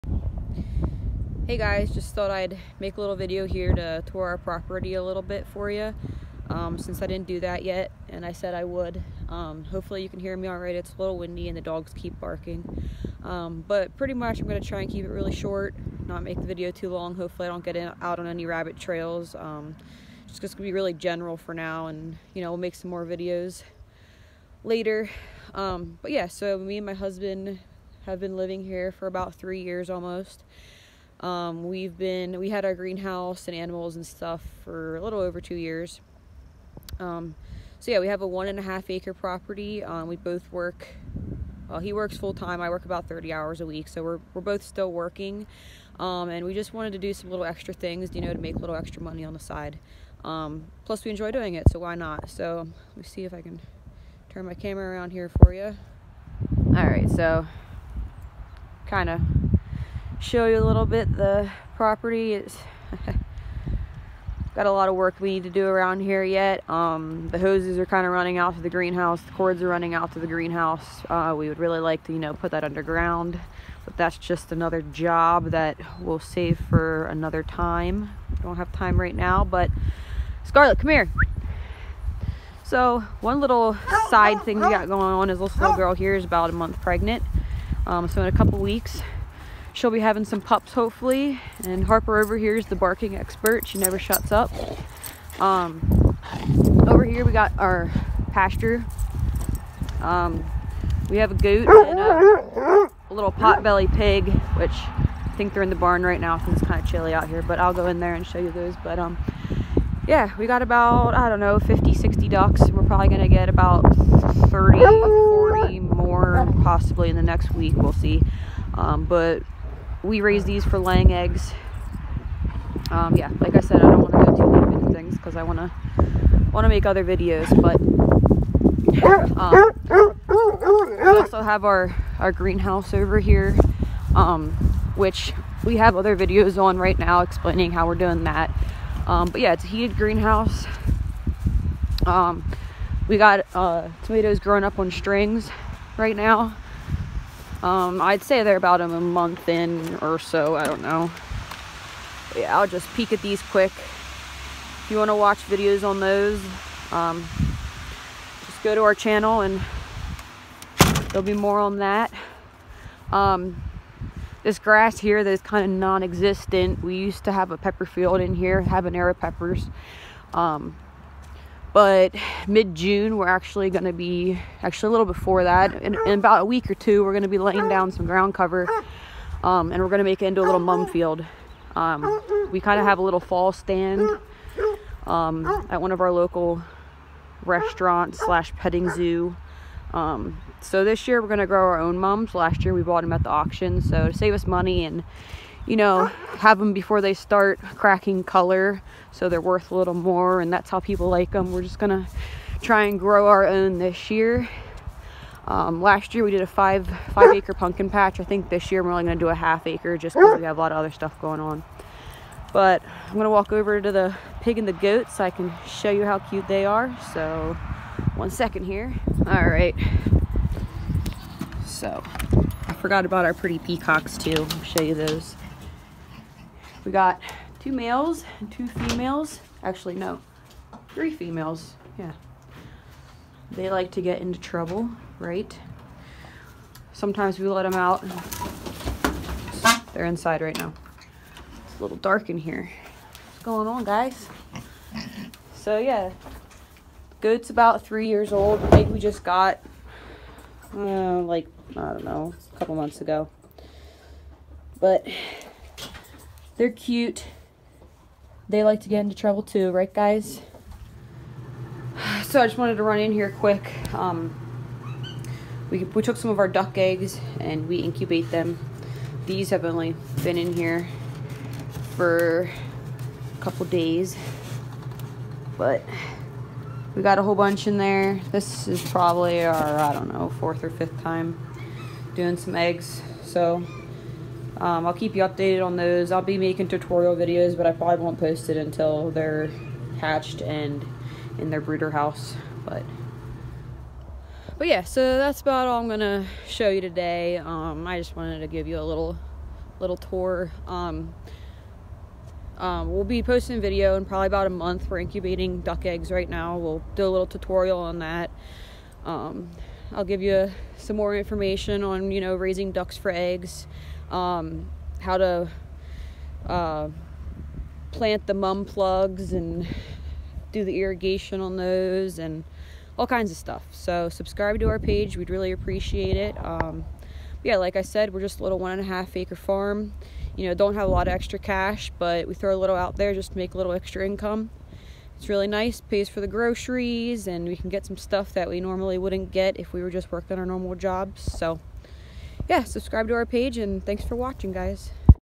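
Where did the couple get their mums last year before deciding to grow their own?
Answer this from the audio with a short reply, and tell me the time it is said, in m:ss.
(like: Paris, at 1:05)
At the auction, at 3:13.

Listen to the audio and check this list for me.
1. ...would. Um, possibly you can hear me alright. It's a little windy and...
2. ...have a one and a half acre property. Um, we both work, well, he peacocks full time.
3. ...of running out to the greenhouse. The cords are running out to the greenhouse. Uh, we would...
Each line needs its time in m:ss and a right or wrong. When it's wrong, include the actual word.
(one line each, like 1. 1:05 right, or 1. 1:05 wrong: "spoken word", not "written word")
1. 0:08 wrong: "hopefully", not "possibly"
2. 0:38 wrong: "works", not "peacocks"
3. 1:08 right.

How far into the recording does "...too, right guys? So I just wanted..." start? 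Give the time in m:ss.
4:19.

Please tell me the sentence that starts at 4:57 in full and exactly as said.
Um, I just wanted to give you a little little tour.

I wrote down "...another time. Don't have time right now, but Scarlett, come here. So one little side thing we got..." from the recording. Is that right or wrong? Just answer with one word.
right.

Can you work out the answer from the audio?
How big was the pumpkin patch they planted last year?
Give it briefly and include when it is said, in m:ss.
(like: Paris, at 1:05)
5 acres, at 3:27.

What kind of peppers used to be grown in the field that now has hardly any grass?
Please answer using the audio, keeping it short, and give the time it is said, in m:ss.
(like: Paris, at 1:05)
Habanero, at 2:48.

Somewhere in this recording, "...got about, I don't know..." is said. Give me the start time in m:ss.
1:50.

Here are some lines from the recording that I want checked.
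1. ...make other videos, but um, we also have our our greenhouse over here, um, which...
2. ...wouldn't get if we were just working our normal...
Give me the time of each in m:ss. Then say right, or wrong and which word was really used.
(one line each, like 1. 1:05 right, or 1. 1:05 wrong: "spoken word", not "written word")
1. 2:06 right
2. 5:38 right.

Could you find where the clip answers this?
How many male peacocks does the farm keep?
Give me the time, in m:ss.
3:47.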